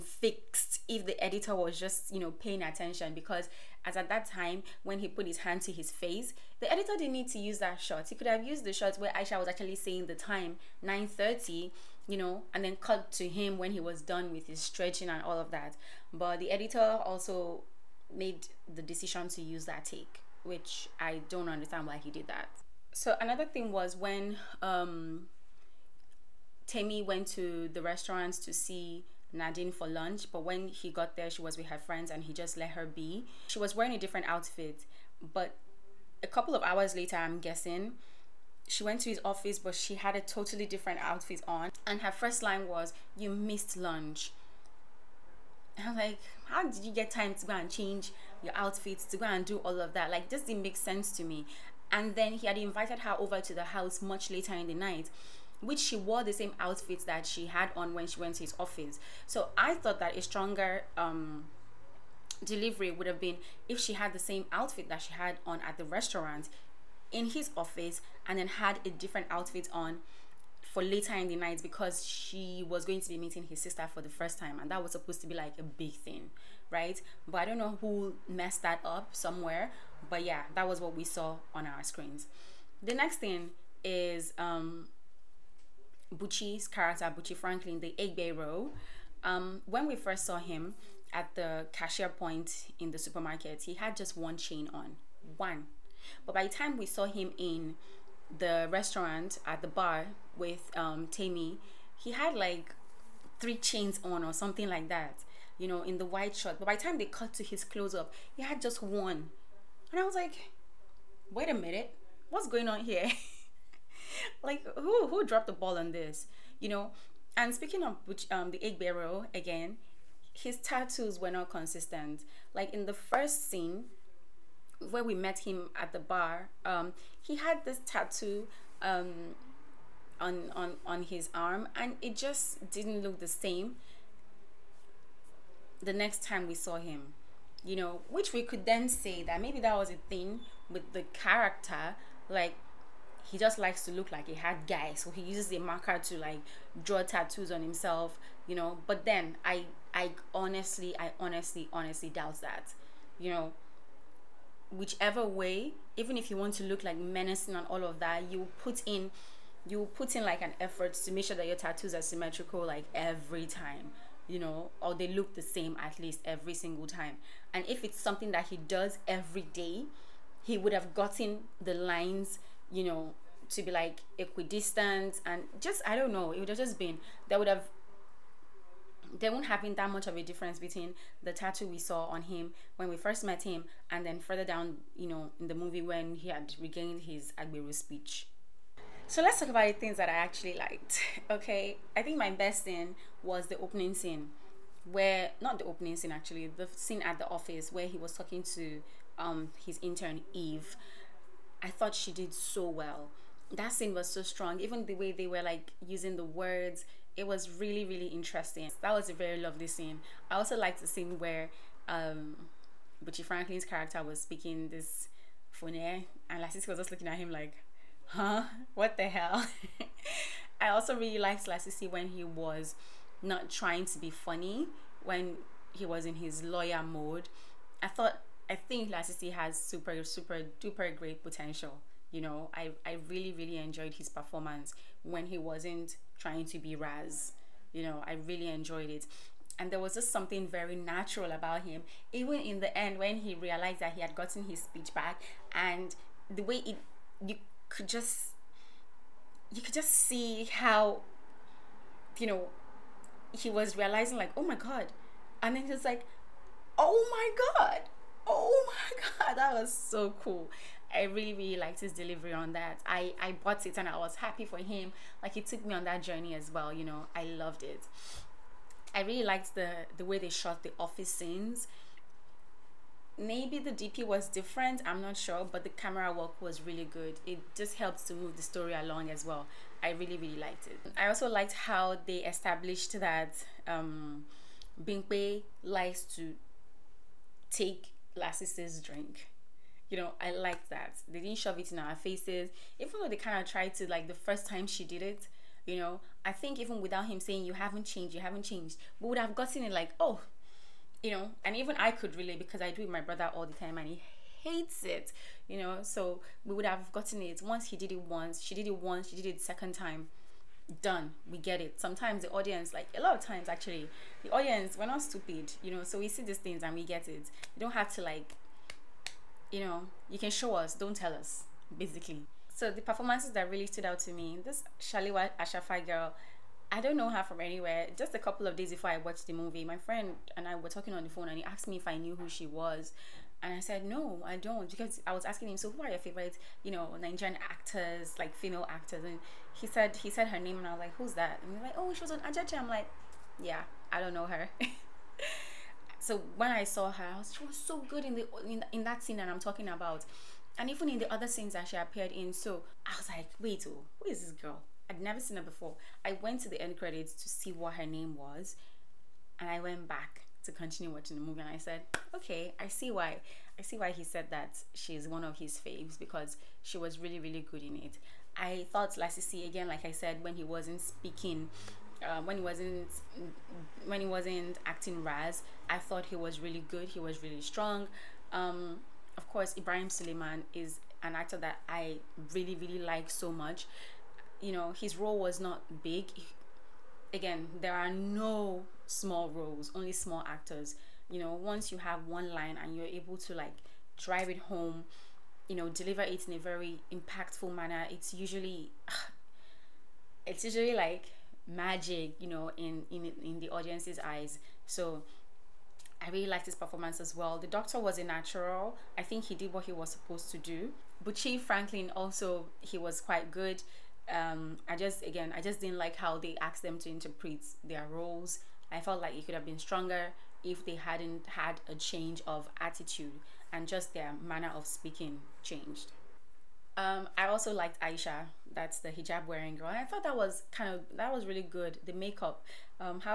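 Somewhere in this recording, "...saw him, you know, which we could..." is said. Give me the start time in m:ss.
2:16.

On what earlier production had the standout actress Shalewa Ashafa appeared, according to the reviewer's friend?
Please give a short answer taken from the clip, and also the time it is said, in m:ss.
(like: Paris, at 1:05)
Ajaja, at 5:42.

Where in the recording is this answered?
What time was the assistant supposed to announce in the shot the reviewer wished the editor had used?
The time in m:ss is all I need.
0:10.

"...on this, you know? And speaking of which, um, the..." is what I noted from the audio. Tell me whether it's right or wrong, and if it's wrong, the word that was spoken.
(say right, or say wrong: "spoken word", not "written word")
right.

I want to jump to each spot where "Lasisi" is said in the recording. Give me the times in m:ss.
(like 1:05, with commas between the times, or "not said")
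3:36, 3:41, 3:48, 4:48, 6:08.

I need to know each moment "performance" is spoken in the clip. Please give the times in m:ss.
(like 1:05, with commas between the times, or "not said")
3:54, 5:22, 6:46.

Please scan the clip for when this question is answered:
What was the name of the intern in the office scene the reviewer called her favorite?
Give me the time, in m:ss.
3:20.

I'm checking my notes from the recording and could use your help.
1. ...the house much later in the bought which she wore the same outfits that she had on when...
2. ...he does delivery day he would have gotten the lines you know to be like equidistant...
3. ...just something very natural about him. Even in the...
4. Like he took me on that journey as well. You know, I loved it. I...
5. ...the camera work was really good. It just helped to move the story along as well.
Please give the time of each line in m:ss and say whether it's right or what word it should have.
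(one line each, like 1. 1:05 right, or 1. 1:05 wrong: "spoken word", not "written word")
1. 0:53 wrong: "night", not "bought"
2. 2:48 wrong: "every", not "delivery"
3. 3:59 right
4. 4:25 right
5. 4:35 right.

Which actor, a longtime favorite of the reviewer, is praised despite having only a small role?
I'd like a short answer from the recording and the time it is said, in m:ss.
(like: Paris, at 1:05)
Ibrahim Suleiman, at 6:19.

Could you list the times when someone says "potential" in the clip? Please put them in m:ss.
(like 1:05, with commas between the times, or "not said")
3:51.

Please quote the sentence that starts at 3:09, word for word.
So let's talk about the things that I actually liked.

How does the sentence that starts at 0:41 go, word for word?
And her first line was, You missed lunch.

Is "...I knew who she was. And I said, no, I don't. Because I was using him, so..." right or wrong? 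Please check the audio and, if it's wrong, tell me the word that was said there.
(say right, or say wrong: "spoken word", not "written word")
wrong: "asking", not "using".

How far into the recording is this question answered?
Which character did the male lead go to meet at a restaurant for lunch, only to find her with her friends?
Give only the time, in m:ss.
0:29.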